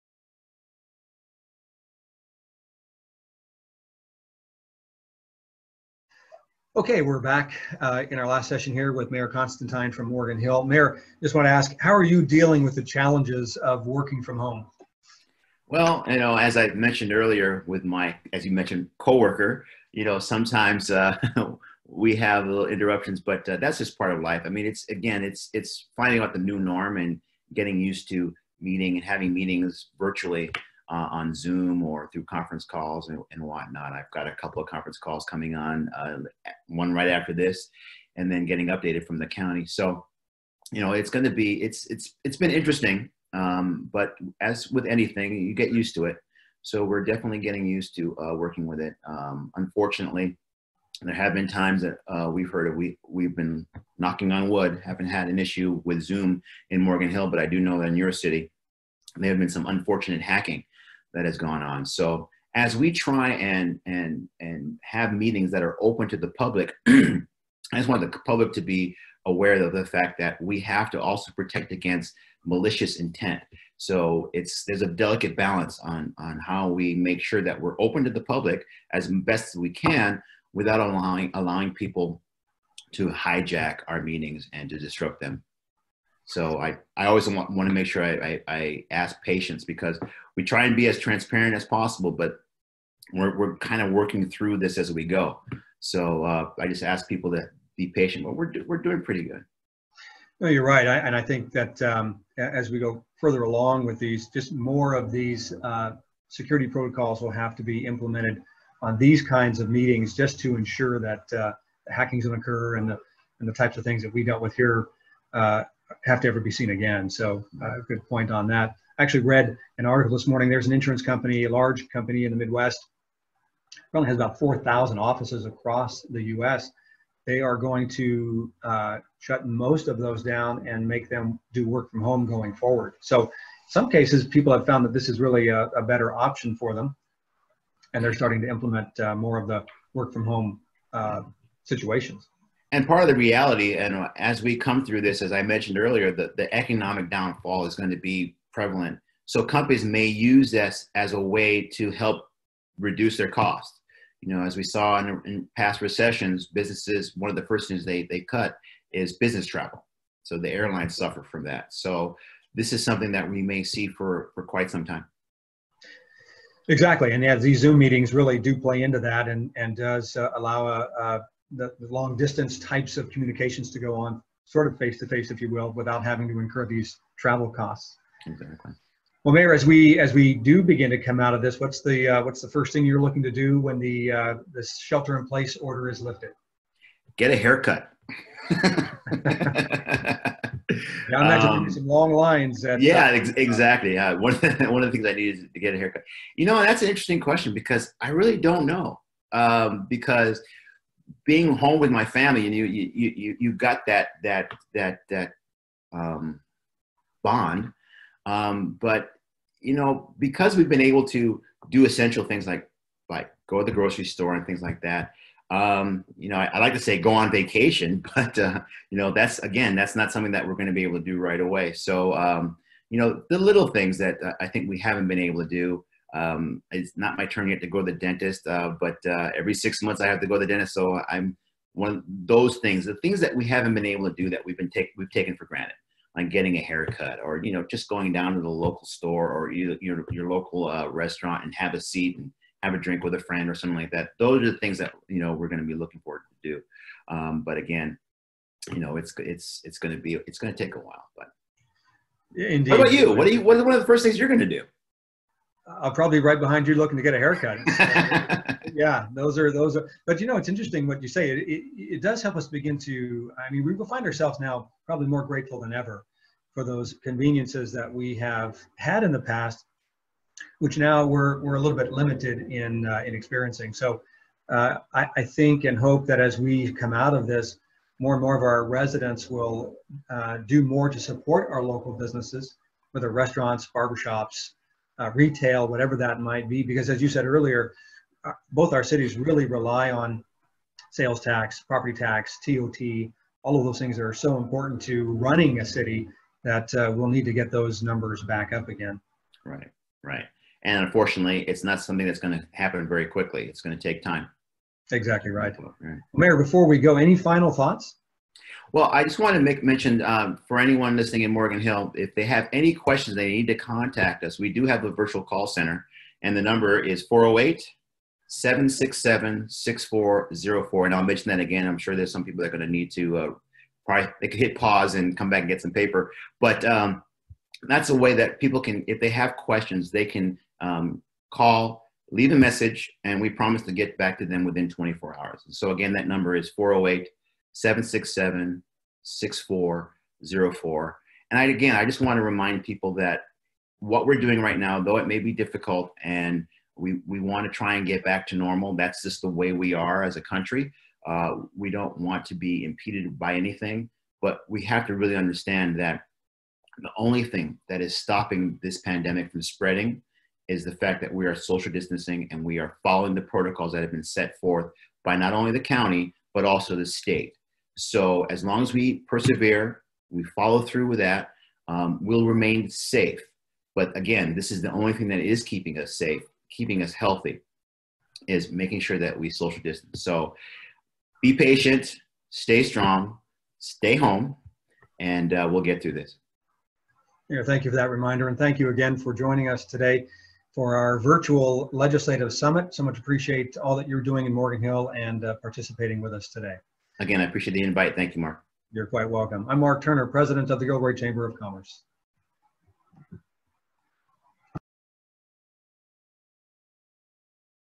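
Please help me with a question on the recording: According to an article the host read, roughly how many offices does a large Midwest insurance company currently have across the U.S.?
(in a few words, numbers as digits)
4,000.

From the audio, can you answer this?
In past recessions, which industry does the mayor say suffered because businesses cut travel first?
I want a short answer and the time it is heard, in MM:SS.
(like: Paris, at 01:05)
airlines, at 02:40.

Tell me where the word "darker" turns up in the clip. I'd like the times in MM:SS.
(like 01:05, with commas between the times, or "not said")
not said.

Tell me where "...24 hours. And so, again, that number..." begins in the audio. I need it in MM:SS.
05:34.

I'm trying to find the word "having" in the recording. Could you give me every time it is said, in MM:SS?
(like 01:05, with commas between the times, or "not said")
00:29, 02:56.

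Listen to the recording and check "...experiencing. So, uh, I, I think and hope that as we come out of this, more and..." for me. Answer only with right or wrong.
right.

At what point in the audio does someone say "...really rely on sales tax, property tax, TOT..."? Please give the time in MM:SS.
04:49.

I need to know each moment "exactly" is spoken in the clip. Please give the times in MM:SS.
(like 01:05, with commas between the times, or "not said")
02:46, 02:58, 03:13, 05:04.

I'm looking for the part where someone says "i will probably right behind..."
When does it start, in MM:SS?
04:15.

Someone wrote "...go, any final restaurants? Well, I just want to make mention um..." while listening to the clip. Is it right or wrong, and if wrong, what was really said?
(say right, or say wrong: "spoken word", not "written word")
wrong: "thoughts", not "restaurants".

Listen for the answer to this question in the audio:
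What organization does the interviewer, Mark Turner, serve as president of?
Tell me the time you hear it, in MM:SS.
06:40.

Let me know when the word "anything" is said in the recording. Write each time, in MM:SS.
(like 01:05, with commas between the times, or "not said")
00:44, 05:53.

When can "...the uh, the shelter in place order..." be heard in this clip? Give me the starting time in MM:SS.
03:03.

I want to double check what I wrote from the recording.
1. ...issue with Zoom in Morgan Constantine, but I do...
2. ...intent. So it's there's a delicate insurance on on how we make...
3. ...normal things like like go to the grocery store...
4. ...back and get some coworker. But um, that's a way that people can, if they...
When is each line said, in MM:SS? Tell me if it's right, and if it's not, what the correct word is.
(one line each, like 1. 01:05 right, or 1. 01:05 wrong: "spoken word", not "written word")
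1. 00:55 wrong: "Hill", not "Constantine"
2. 01:12 wrong: "balance", not "insurance"
3. 03:31 wrong: "essential", not "normal"
4. 05:25 wrong: "paper", not "coworker".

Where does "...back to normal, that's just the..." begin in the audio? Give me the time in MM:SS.
05:48.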